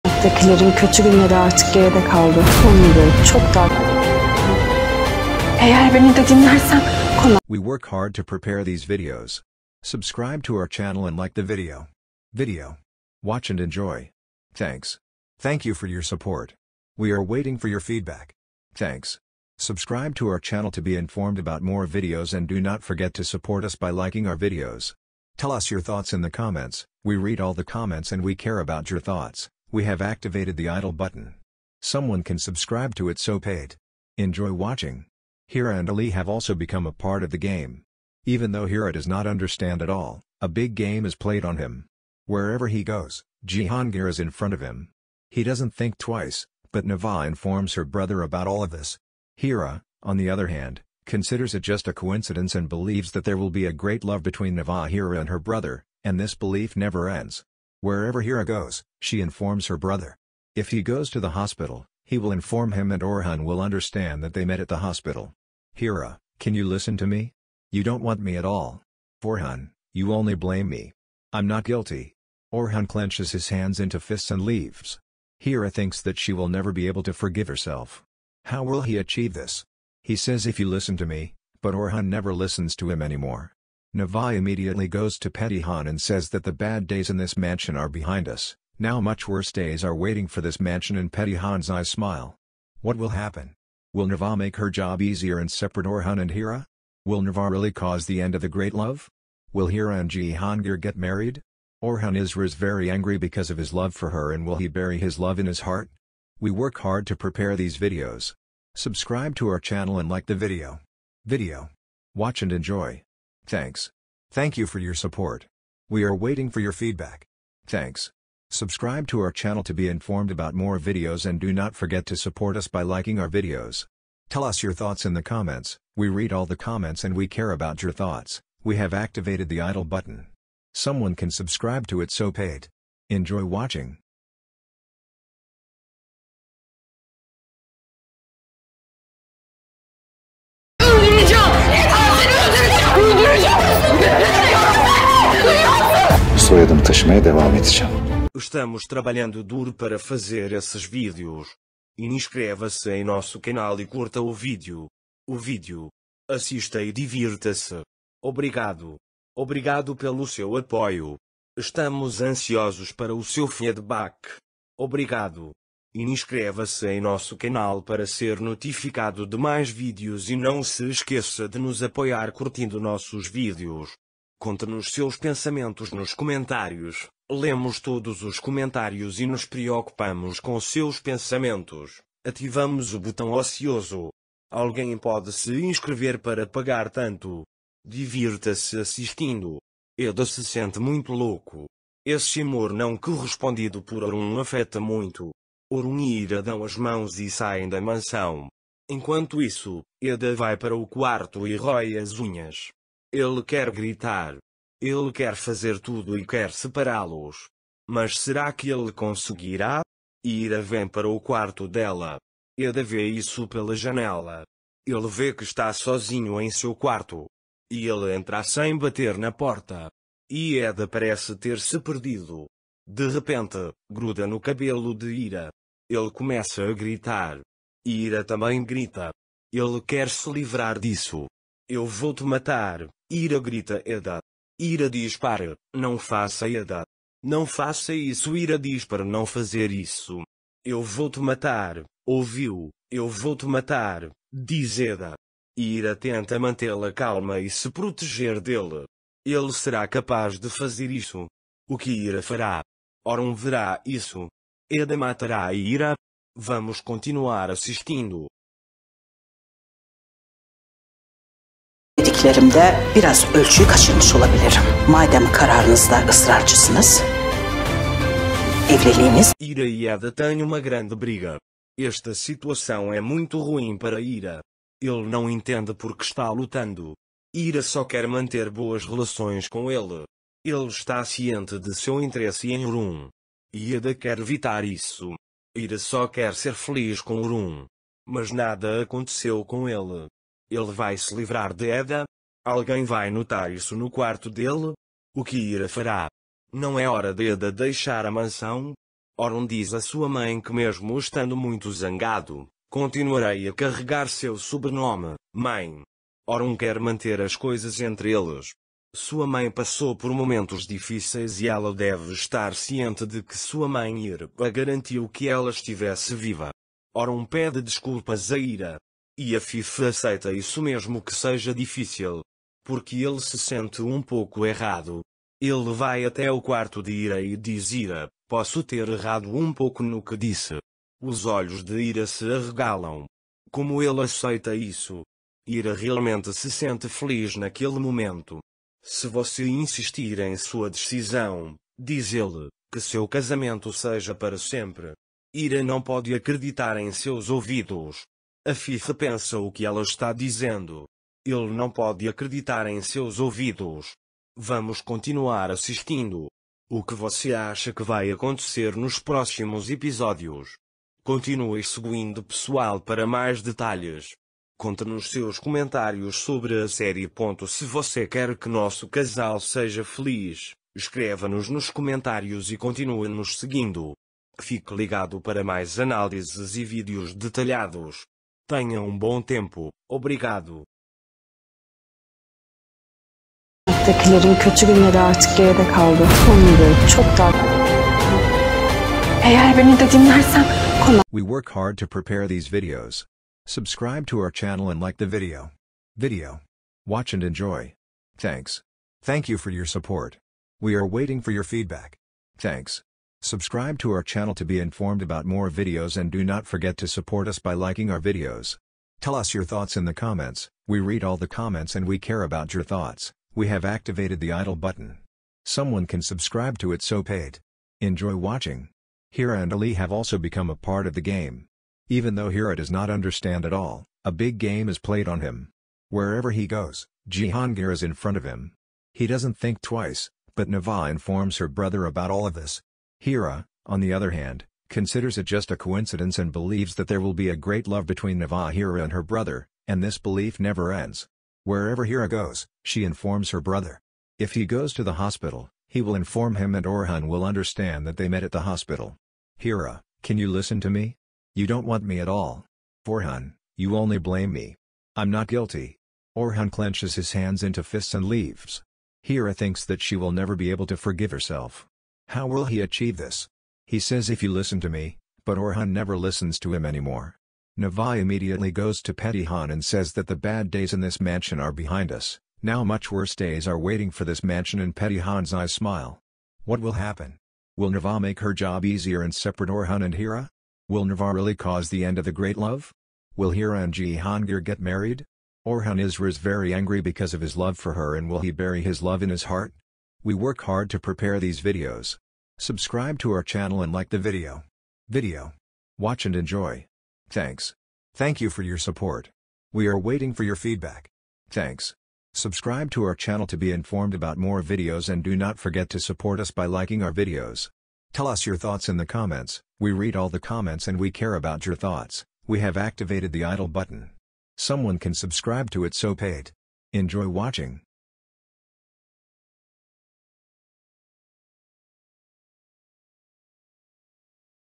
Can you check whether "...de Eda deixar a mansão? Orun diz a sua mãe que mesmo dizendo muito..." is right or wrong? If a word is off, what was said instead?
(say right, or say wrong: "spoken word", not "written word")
wrong: "estando", not "dizendo".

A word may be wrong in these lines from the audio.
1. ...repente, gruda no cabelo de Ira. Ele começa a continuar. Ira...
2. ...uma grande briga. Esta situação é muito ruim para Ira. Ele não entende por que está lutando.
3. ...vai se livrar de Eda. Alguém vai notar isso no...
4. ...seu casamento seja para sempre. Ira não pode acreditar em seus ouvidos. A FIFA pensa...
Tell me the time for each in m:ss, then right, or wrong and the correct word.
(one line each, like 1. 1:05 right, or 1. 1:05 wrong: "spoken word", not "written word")
1. 3:43 wrong: "gritar", not "continuar"
2. 4:30 right
3. 4:50 right
4. 5:42 right.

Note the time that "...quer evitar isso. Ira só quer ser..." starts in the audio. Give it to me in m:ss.
4:43.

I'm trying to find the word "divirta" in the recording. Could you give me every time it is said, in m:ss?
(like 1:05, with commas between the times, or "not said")
2:36, 3:07.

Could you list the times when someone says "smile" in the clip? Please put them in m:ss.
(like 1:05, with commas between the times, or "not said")
1:31, 7:55.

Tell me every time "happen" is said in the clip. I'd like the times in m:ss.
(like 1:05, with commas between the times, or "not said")
1:33, 7:56.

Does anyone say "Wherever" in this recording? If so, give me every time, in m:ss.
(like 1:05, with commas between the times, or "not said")
0:42, 0:57, 7:05, 7:21.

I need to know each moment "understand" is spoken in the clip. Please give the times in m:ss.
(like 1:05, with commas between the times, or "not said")
0:39, 1:03, 7:02, 7:27.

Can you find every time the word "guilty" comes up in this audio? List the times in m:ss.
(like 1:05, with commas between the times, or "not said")
1:11, 7:35.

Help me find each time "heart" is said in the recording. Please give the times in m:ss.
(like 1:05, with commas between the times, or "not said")
1:45, 8:09.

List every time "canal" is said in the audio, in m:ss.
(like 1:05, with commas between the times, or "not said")
2:33, 2:47.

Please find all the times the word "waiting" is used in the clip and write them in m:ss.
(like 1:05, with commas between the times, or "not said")
0:17, 1:29, 1:56, 6:40, 7:53, 8:19.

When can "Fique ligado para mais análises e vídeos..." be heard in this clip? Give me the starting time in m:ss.
6:14.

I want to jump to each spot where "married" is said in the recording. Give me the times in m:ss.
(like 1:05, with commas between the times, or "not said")
1:40, 8:04.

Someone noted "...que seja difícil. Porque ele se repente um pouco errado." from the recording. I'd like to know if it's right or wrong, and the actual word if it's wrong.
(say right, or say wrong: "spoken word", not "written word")
wrong: "sente", not "repente".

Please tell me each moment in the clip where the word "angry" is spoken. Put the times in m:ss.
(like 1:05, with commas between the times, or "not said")
1:42, 8:06.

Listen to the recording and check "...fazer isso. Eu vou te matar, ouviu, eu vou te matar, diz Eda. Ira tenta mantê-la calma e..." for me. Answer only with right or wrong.
right.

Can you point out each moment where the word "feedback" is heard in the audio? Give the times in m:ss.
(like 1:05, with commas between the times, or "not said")
0:17, 1:56, 2:43, 6:41, 8:20.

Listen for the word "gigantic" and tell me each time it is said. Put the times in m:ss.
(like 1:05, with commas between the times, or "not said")
not said.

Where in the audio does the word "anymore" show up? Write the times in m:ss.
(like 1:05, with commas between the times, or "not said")
1:23, 7:46.